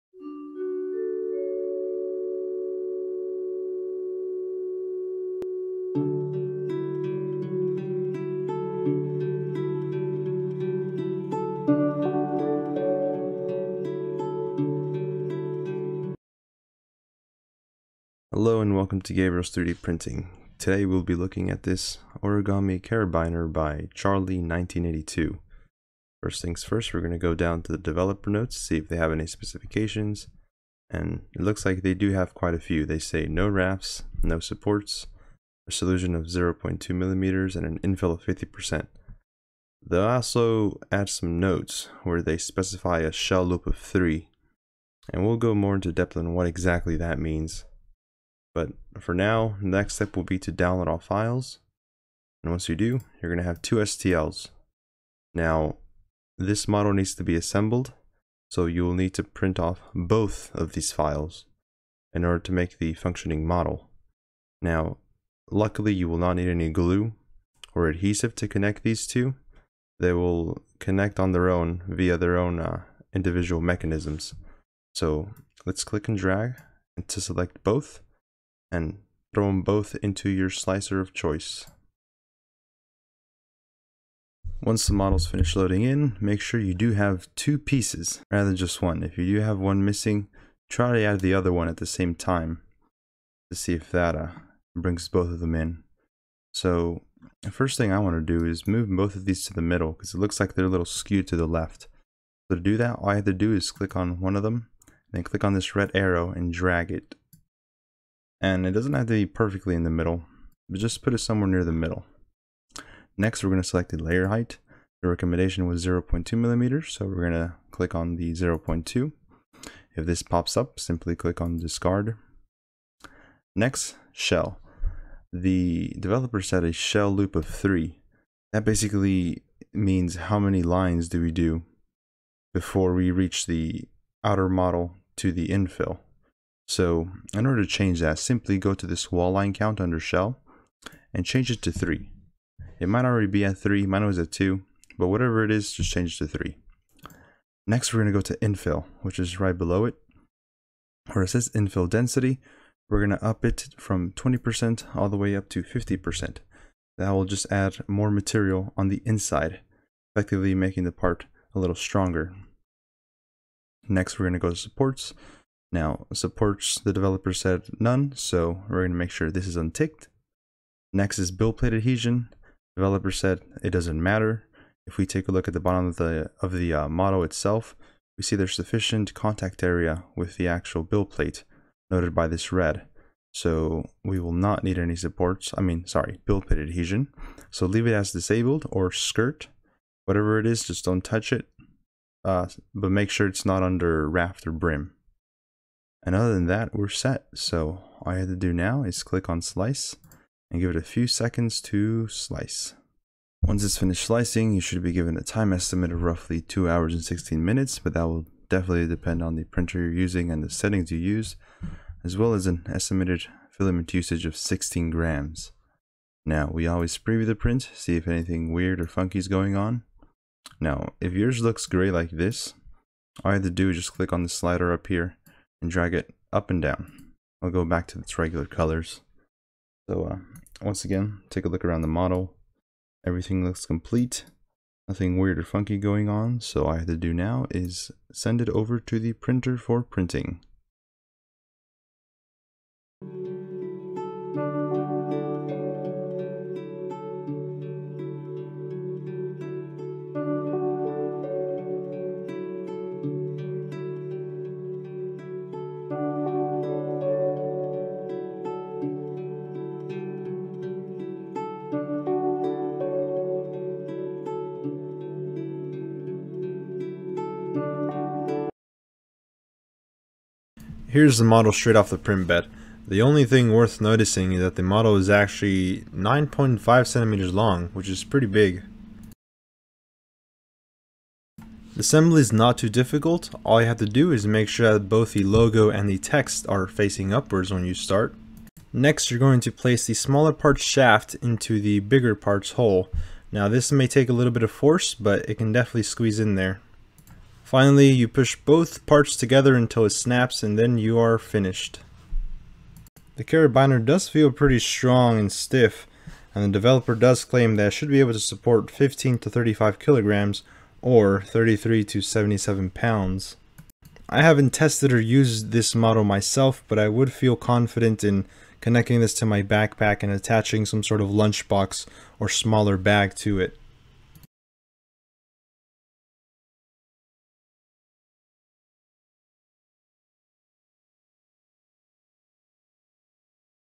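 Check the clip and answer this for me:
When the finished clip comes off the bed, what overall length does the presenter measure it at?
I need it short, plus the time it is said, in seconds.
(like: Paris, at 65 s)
9.5 centimeters, at 275 s.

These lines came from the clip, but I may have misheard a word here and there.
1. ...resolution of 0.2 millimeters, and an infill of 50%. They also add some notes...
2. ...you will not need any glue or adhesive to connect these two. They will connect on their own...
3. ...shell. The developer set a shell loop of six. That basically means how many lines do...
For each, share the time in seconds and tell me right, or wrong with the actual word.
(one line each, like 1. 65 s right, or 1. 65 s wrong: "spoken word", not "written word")
1. 35 s right
2. 65 s right
3. 124 s wrong: "three", not "six".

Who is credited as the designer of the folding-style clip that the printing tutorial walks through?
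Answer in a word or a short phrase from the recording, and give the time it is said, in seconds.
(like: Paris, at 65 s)
Charlie1982, at 23 s.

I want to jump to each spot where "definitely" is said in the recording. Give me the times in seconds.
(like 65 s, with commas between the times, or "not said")
208 s, 295 s.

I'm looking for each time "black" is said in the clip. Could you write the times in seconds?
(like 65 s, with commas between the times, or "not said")
not said.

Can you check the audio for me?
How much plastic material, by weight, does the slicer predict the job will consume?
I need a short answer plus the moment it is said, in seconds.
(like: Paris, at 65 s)
16 grams, at 214 s.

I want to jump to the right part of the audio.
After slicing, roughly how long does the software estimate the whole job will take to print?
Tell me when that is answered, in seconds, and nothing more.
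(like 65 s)
206 s.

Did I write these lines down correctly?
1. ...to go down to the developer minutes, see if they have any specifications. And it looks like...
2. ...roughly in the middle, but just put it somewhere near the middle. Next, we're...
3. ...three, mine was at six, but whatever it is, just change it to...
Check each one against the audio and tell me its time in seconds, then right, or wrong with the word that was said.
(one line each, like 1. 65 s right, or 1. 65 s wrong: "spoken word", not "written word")
1. 27 s wrong: "notes", not "minutes"
2. 109 s wrong: "perfectly", not "roughly"
3. 143 s wrong: "two", not "six".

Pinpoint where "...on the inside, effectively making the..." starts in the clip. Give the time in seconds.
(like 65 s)
158 s.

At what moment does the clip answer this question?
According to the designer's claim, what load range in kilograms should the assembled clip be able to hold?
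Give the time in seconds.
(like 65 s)
308 s.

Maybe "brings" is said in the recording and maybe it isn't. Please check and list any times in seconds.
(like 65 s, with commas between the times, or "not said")
94 s.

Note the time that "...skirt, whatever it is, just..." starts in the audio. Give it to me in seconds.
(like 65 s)
188 s.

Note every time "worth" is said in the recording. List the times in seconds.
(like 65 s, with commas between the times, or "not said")
273 s.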